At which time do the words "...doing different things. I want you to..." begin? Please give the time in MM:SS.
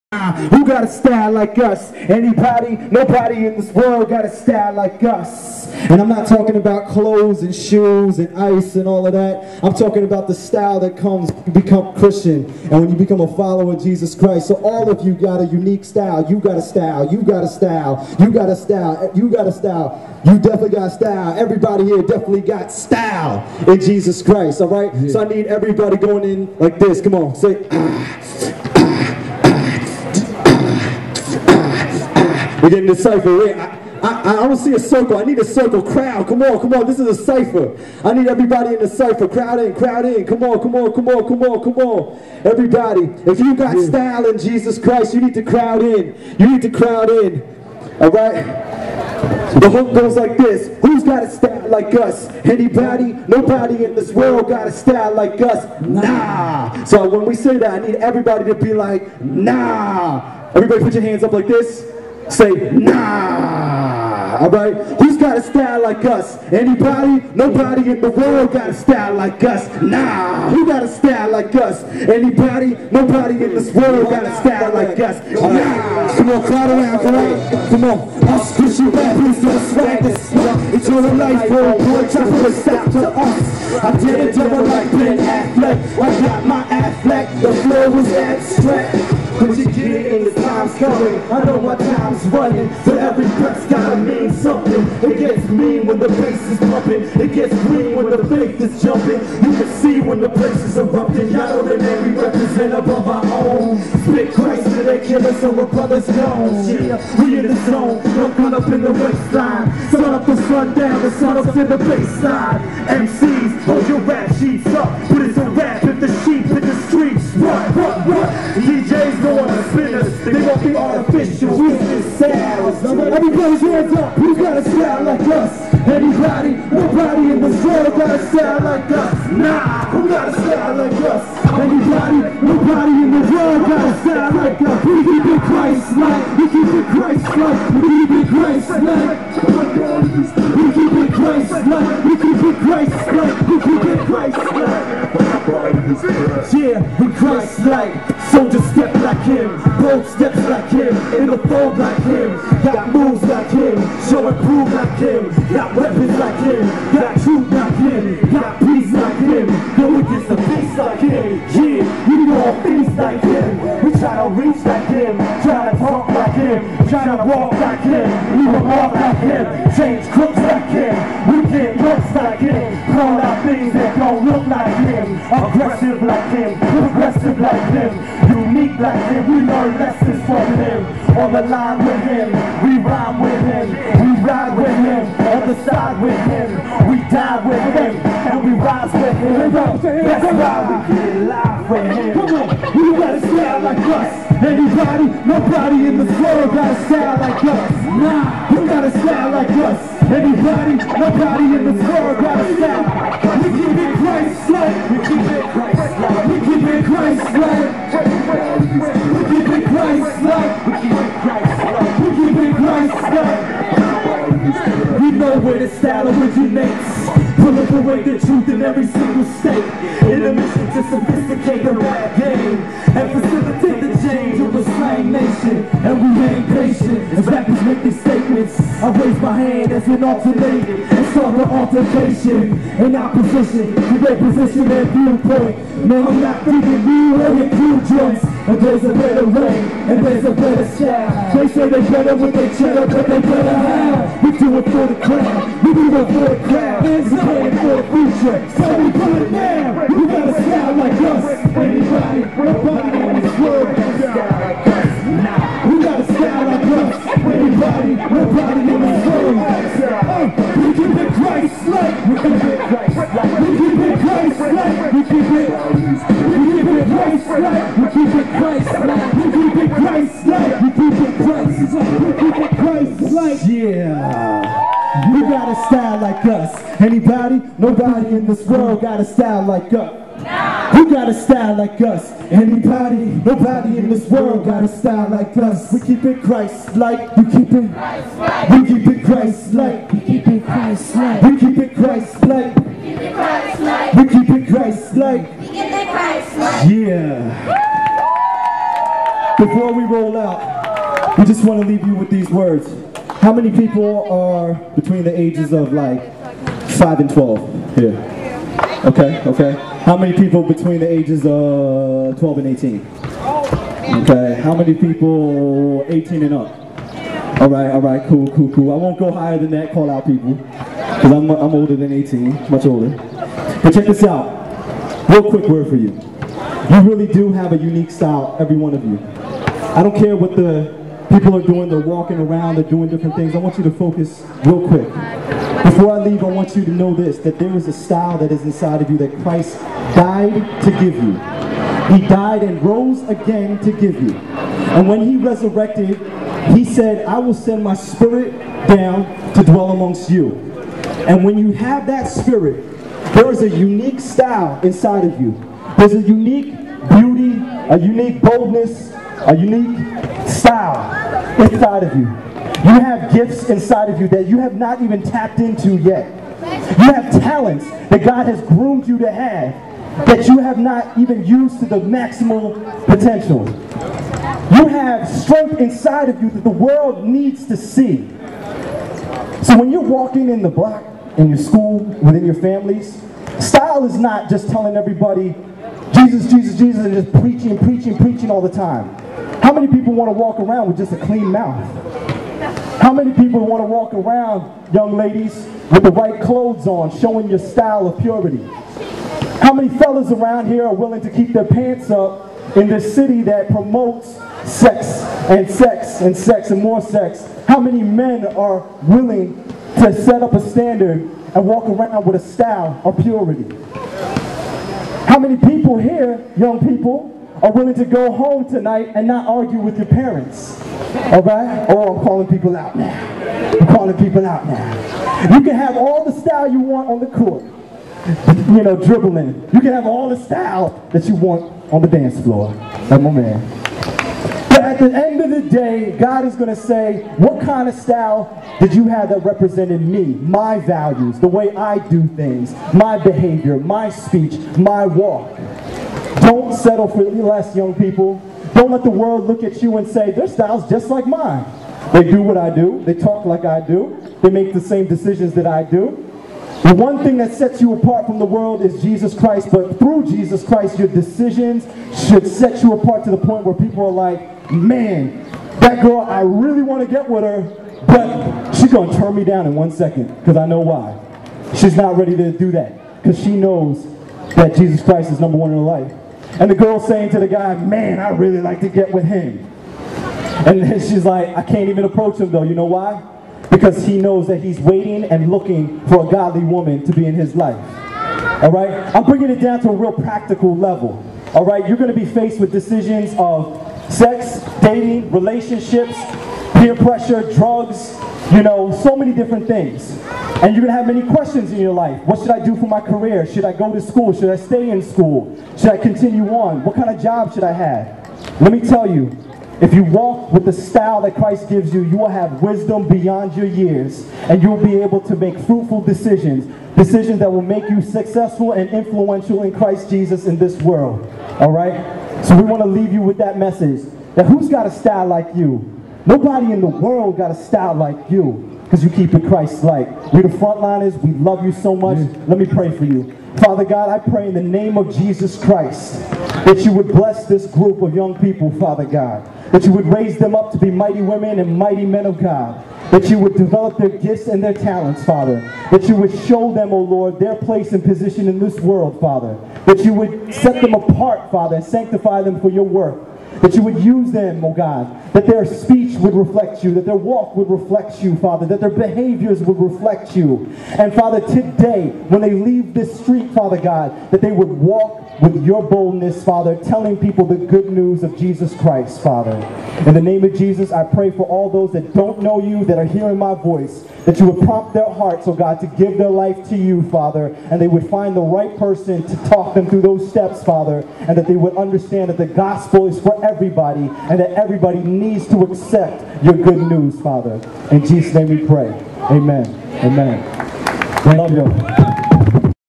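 05:32.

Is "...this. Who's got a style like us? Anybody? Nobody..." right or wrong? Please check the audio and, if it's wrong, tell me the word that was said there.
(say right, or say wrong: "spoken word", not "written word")
right.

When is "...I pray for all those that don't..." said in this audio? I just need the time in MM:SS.
09:30.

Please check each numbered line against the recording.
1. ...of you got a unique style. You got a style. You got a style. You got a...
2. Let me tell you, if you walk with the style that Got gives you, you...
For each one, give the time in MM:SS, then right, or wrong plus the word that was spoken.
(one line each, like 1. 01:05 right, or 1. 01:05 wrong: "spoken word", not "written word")
1. 00:14 right
2. 08:28 wrong: "Christ", not "Got".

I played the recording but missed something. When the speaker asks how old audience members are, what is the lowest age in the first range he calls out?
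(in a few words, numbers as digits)
5.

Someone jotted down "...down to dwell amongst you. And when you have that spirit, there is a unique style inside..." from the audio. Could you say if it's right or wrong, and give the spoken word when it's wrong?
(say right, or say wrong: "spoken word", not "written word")
right.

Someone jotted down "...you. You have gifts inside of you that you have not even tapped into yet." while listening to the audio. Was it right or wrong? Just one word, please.
right.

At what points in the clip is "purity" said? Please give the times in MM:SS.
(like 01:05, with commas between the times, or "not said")
06:38, 06:53.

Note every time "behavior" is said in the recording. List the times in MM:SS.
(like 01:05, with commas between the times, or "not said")
07:22, 09:18.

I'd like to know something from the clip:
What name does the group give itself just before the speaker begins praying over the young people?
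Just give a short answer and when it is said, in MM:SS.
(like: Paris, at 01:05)
Frontlynaz, at 08:50.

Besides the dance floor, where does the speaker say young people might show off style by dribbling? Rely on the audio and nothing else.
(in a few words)
the court.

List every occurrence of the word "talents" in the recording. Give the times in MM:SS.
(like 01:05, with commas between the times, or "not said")
06:07, 09:04.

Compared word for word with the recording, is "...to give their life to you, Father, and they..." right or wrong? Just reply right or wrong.
right.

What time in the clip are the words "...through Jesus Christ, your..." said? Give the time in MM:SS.
07:39.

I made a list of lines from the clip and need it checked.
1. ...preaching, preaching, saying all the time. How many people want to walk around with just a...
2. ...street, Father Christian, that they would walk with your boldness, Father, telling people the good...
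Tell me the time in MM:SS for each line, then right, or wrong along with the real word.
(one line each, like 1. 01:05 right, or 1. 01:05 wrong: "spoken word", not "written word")
1. 06:27 wrong: "preaching", not "saying"
2. 09:22 wrong: "God", not "Christian".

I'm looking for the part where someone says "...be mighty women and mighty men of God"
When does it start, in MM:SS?
09:00.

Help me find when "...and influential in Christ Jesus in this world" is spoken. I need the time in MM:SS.
08:38.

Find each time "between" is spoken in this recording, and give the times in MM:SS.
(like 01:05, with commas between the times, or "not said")
05:04, 05:10.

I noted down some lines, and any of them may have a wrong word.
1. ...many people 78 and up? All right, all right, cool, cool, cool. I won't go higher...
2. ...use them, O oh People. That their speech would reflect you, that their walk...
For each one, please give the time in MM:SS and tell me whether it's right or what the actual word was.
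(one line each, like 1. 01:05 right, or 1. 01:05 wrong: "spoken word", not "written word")
1. 05:14 wrong: "18", not "78"
2. 09:13 wrong: "God", not "People".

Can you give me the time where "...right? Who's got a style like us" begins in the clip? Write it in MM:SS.
01:04.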